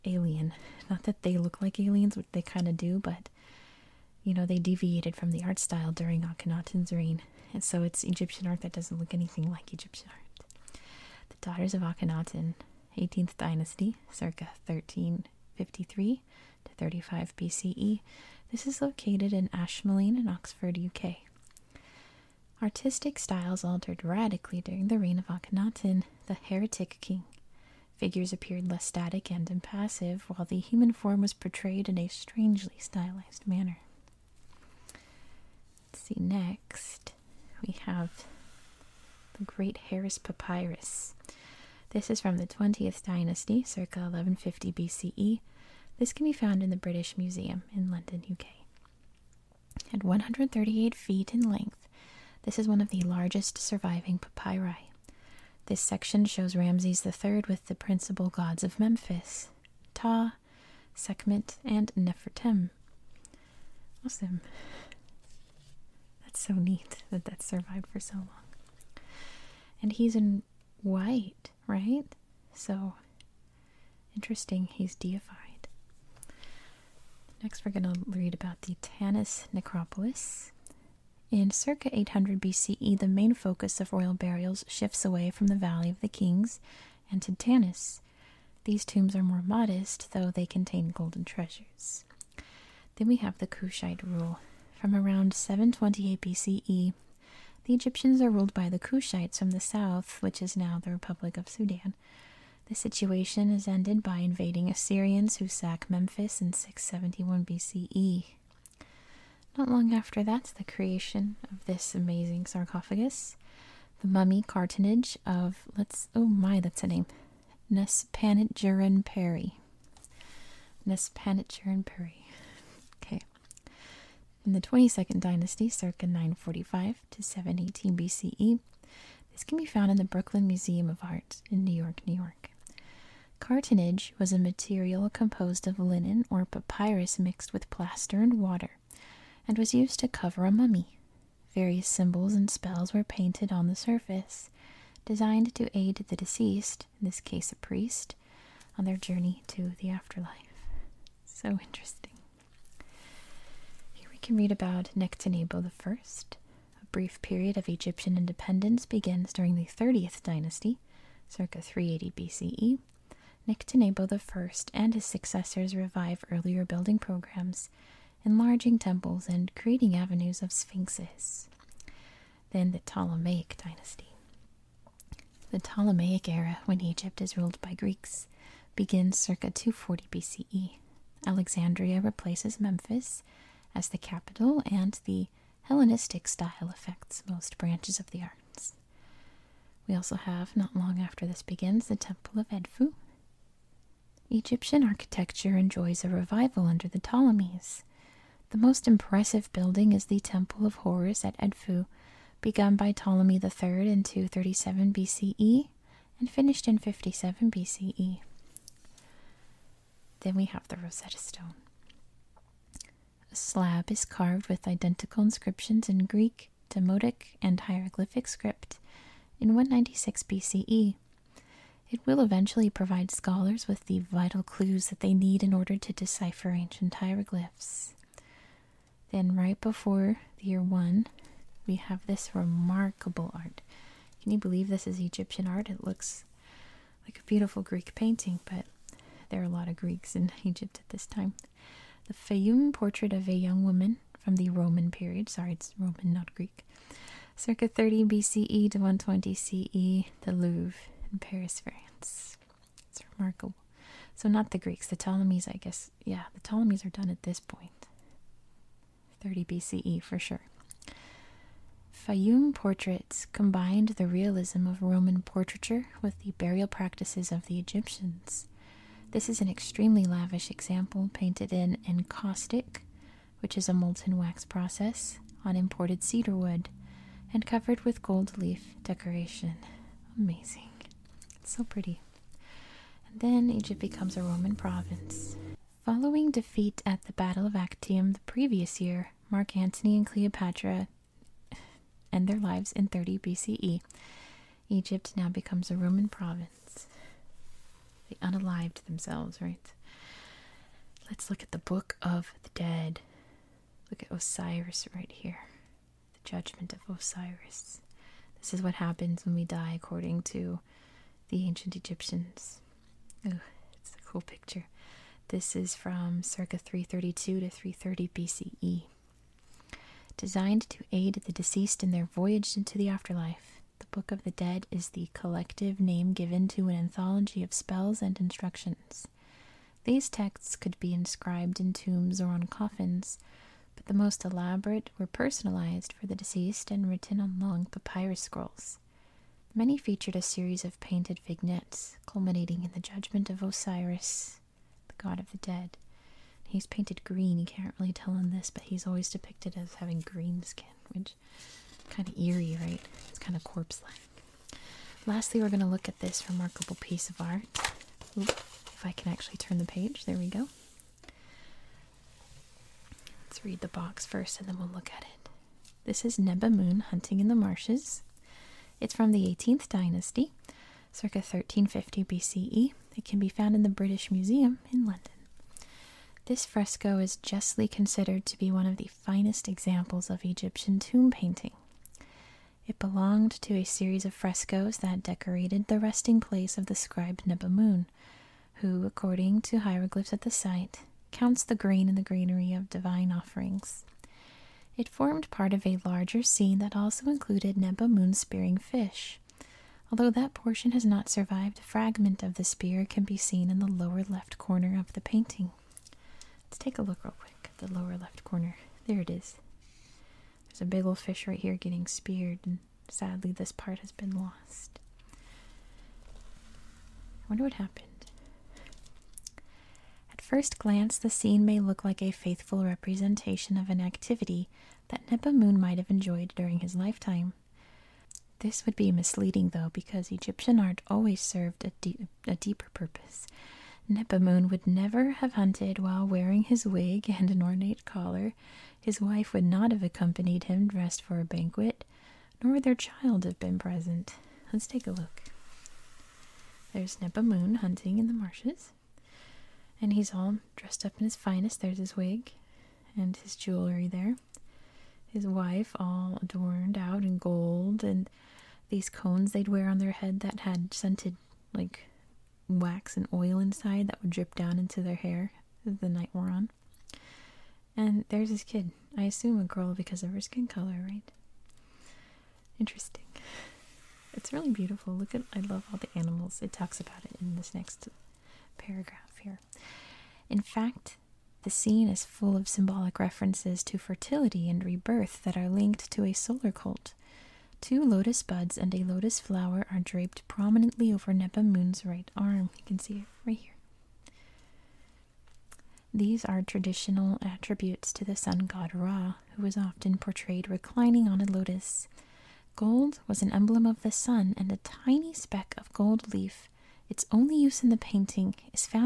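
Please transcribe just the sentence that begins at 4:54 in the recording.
Egypt now becomes a Roman province.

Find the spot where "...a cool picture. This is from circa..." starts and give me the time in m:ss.
5:13.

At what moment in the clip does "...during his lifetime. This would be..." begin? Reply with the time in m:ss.
7:06.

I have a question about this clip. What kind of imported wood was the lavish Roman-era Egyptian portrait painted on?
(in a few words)
cedar.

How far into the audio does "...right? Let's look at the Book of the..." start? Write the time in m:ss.
4:59.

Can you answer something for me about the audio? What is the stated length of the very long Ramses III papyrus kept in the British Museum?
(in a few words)
138 feet.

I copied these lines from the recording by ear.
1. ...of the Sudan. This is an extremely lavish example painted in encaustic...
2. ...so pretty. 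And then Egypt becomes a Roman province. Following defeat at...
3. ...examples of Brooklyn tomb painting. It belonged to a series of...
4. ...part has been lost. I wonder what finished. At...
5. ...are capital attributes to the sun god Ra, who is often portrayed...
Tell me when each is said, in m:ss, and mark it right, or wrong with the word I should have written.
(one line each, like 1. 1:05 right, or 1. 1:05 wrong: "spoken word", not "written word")
1. 4:27 wrong: "Egyptians", not "Sudan"
2. 4:41 right
3. 6:19 wrong: "Egyptian", not "Brooklyn"
4. 6:53 wrong: "happened", not "finished"
5. 8:16 wrong: "traditional", not "capital".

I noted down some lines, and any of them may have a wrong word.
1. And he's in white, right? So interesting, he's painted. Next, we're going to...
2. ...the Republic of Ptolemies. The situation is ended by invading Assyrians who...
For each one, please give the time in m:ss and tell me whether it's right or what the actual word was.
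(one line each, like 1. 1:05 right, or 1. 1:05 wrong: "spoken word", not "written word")
1. 1:09 wrong: "deified", not "painted"
2. 1:40 wrong: "Sudan", not "Ptolemies".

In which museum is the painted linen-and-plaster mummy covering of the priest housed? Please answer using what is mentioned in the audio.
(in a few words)
Brooklyn Museum of Art.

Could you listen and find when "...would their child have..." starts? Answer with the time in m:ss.
7:22.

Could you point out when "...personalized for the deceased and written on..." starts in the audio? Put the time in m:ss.
5:35.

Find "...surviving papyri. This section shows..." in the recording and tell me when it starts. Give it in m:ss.
0:53.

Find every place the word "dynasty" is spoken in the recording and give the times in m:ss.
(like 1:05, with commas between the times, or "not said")
0:13, 0:43, 2:05, 2:40, 2:53, 6:09.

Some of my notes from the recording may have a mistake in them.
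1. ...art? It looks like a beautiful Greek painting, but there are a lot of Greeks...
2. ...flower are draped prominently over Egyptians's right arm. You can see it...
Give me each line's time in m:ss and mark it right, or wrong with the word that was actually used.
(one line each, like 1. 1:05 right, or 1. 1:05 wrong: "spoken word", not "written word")
1. 3:55 right
2. 8:09 wrong: "Nebamun", not "Egyptians".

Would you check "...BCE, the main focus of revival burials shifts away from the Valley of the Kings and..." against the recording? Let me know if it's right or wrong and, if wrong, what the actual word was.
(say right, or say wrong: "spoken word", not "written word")
wrong: "royal", not "revival".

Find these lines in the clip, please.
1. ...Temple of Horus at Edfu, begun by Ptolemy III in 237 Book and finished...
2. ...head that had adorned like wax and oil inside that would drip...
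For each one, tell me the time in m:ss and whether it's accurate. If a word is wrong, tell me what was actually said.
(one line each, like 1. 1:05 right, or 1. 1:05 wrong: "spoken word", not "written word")
1. 3:20 wrong: "BCE", not "Book"
2. 7:39 wrong: "scented", not "adorned".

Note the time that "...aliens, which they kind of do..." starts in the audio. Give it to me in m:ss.
0:01.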